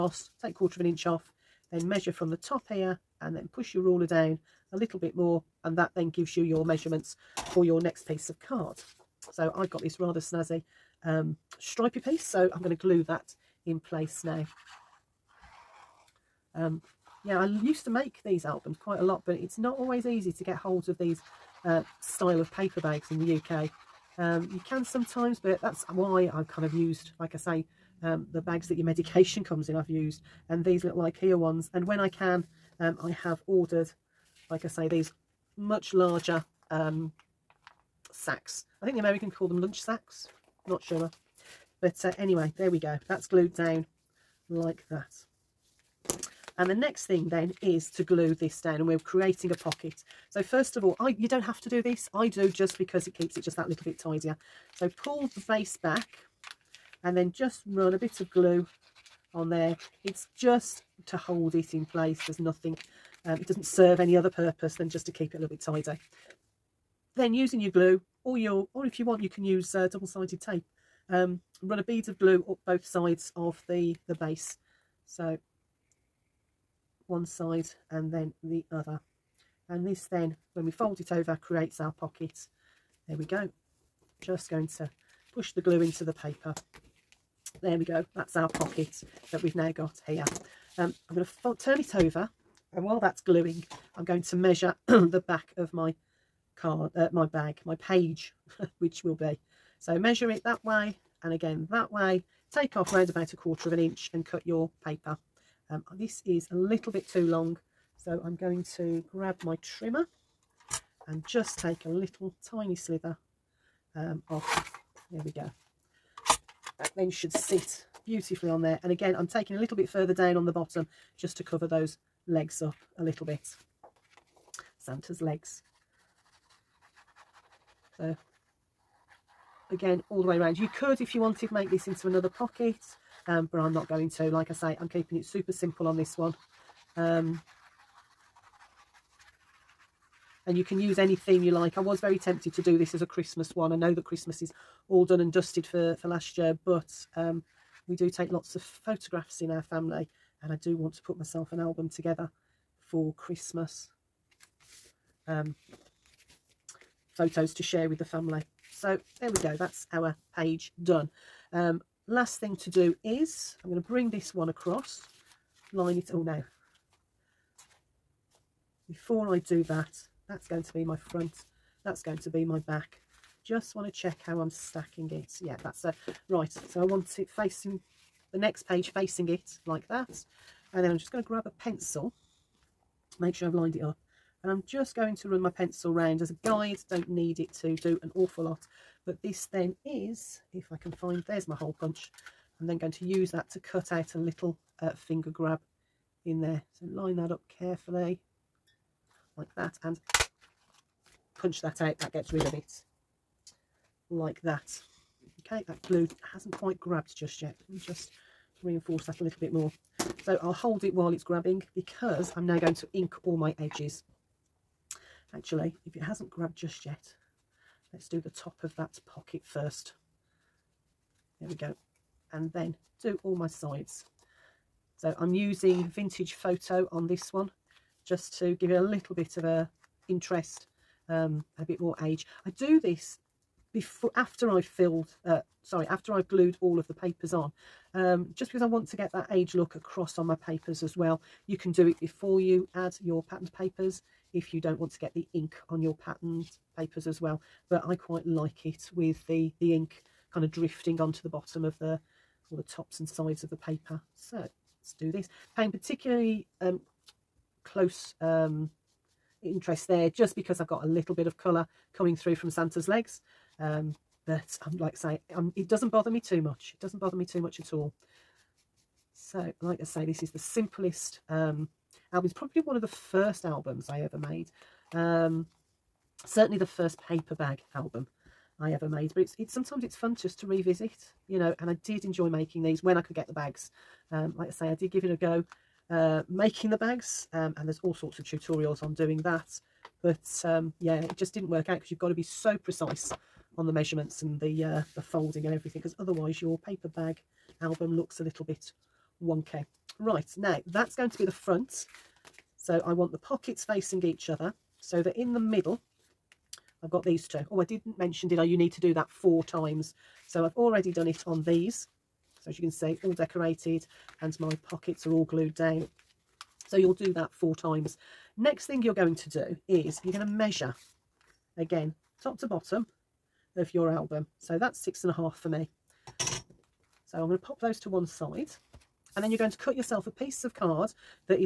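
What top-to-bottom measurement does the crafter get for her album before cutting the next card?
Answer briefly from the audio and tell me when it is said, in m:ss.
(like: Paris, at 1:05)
6.5, at 5:24.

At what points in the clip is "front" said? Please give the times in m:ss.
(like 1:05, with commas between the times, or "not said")
2:50, 5:01.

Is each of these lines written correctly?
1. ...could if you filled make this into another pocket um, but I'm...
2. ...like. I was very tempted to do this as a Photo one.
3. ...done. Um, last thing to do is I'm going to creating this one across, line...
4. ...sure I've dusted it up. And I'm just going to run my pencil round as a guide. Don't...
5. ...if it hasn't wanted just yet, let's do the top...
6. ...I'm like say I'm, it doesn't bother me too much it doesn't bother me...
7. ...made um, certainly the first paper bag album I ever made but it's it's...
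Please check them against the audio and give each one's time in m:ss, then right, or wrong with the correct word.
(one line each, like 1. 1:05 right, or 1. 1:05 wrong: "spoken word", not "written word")
1. 2:10 wrong: "wanted", not "filled"
2. 2:21 wrong: "Christmas", not "Photo"
3. 2:40 wrong: "bring", not "creating"
4. 3:03 wrong: "lined", not "dusted"
5. 3:35 wrong: "grabbed", not "wanted"
6. 4:24 right
7. 4:34 right.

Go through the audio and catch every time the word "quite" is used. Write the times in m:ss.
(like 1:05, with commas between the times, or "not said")
0:18, 3:26, 4:07.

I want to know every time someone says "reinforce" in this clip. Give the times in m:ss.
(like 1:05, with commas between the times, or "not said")
3:28.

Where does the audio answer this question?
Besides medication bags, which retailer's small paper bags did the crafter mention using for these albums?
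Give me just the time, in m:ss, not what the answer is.
0:31.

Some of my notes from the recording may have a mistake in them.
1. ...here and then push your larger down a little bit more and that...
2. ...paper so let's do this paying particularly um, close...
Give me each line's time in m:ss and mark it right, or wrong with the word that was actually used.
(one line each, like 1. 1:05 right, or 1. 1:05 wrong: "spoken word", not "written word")
1. 0:02 wrong: "ruler", not "larger"
2. 4:13 right.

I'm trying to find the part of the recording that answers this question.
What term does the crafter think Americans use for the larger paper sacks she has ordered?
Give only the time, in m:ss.
0:39.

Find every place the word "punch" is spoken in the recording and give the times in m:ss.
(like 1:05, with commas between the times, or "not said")
3:11, 3:21.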